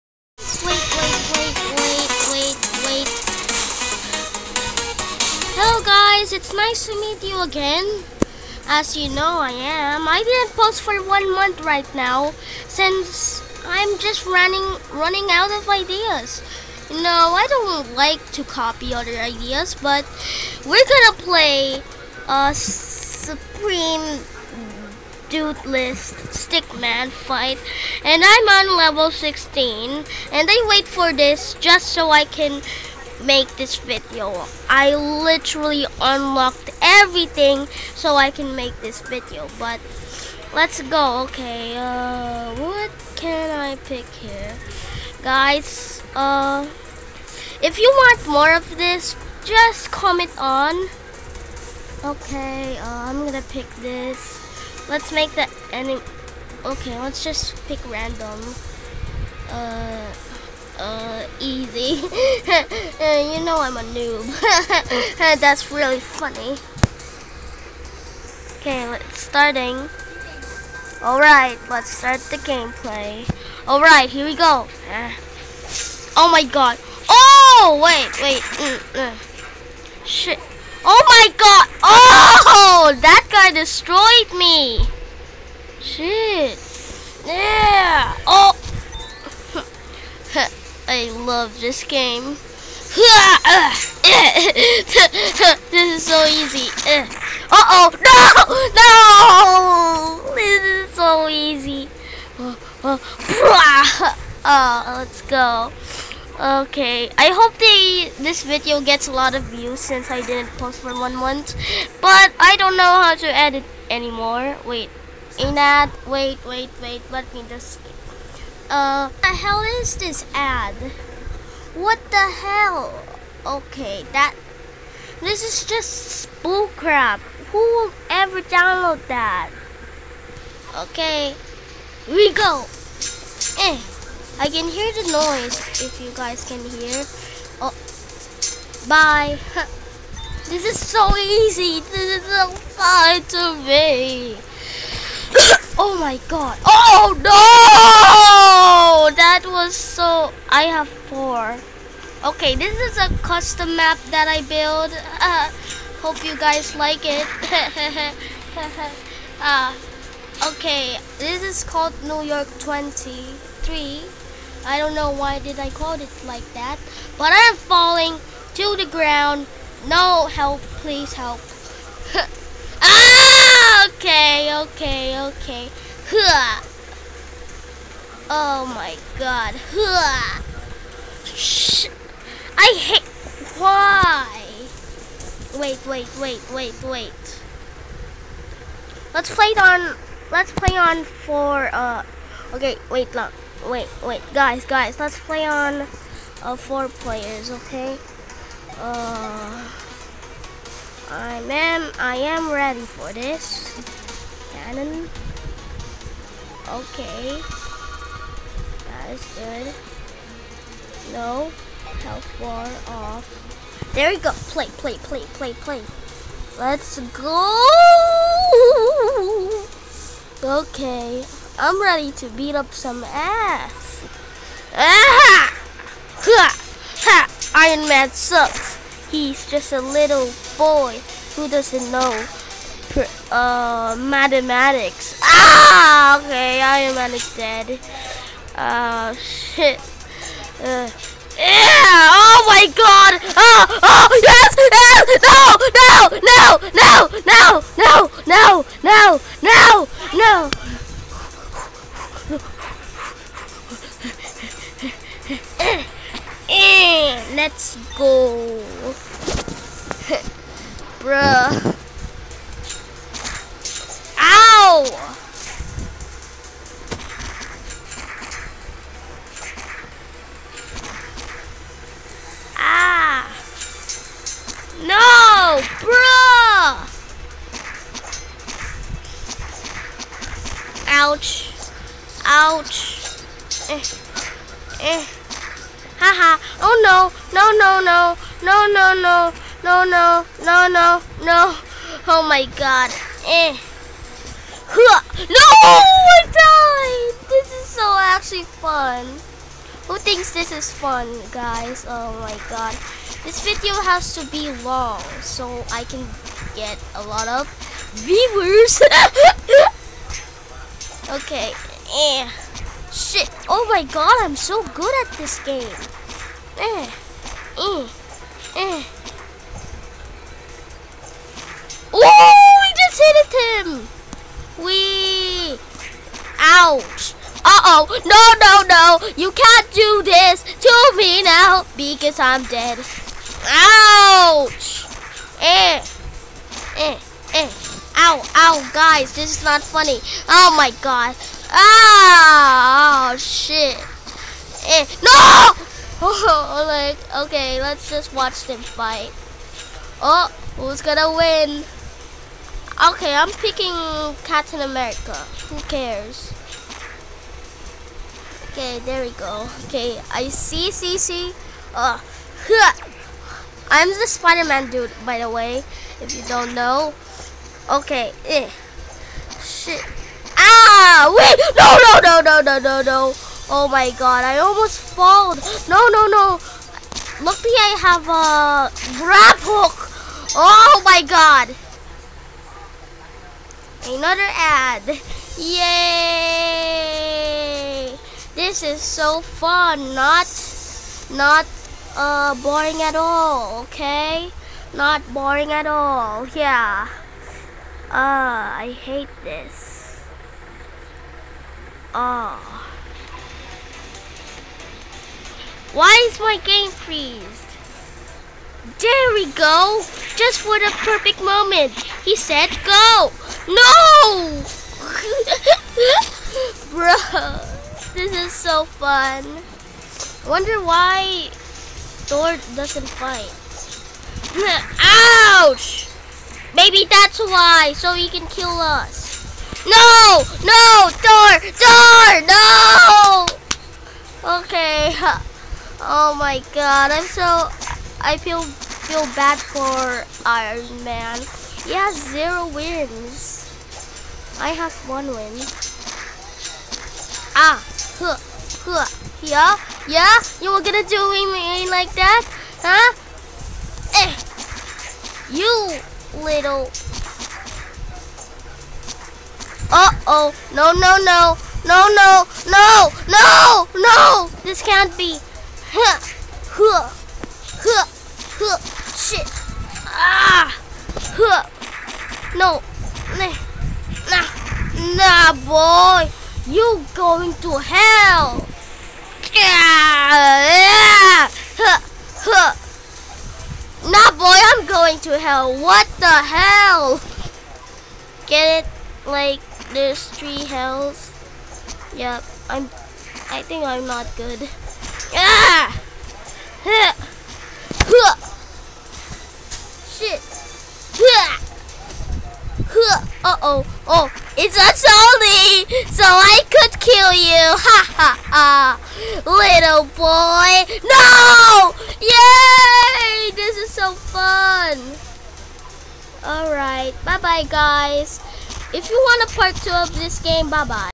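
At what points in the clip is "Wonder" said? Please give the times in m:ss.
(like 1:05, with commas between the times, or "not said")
7:00.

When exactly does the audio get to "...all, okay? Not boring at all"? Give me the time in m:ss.
6:32.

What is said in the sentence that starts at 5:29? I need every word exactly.
You can't do this to me now because I'm dead.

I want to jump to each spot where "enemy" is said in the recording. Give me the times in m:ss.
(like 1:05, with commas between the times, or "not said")
0:55.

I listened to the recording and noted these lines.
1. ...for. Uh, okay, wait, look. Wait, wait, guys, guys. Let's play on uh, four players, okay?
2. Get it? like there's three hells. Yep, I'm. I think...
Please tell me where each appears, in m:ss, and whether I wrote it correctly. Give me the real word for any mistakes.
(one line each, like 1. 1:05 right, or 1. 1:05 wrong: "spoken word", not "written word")
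1. 3:11 right
2. 8:08 right.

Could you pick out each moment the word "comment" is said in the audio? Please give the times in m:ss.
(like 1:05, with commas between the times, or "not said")
0:49.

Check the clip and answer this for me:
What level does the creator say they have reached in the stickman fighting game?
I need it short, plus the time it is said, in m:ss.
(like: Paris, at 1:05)
16, at 0:28.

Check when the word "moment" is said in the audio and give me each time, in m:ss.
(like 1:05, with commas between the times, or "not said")
6:51.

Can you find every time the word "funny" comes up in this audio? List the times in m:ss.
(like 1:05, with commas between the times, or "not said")
1:05, 5:39.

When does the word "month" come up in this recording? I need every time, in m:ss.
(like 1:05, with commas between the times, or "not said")
0:11, 1:51.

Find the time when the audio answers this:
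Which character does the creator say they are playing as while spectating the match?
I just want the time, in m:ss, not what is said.
6:04.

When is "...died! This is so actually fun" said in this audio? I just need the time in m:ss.
4:56.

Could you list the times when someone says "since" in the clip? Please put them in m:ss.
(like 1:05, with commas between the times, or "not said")
0:12, 1:49.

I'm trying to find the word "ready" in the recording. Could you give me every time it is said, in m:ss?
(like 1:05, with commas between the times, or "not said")
3:22, 3:41.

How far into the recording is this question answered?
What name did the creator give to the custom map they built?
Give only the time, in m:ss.
2:42.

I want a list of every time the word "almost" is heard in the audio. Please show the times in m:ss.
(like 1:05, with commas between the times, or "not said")
6:14.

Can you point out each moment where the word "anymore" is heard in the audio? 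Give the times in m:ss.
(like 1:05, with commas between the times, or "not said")
1:53.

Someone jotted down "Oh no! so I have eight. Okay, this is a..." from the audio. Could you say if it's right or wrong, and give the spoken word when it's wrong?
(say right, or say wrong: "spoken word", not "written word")
wrong: "four", not "eight".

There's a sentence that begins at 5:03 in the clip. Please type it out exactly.
This video has to be long so I can get a lot of viewers.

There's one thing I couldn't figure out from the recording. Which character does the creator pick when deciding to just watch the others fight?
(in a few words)
Captain America.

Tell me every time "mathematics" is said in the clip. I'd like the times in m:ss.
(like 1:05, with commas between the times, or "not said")
3:53.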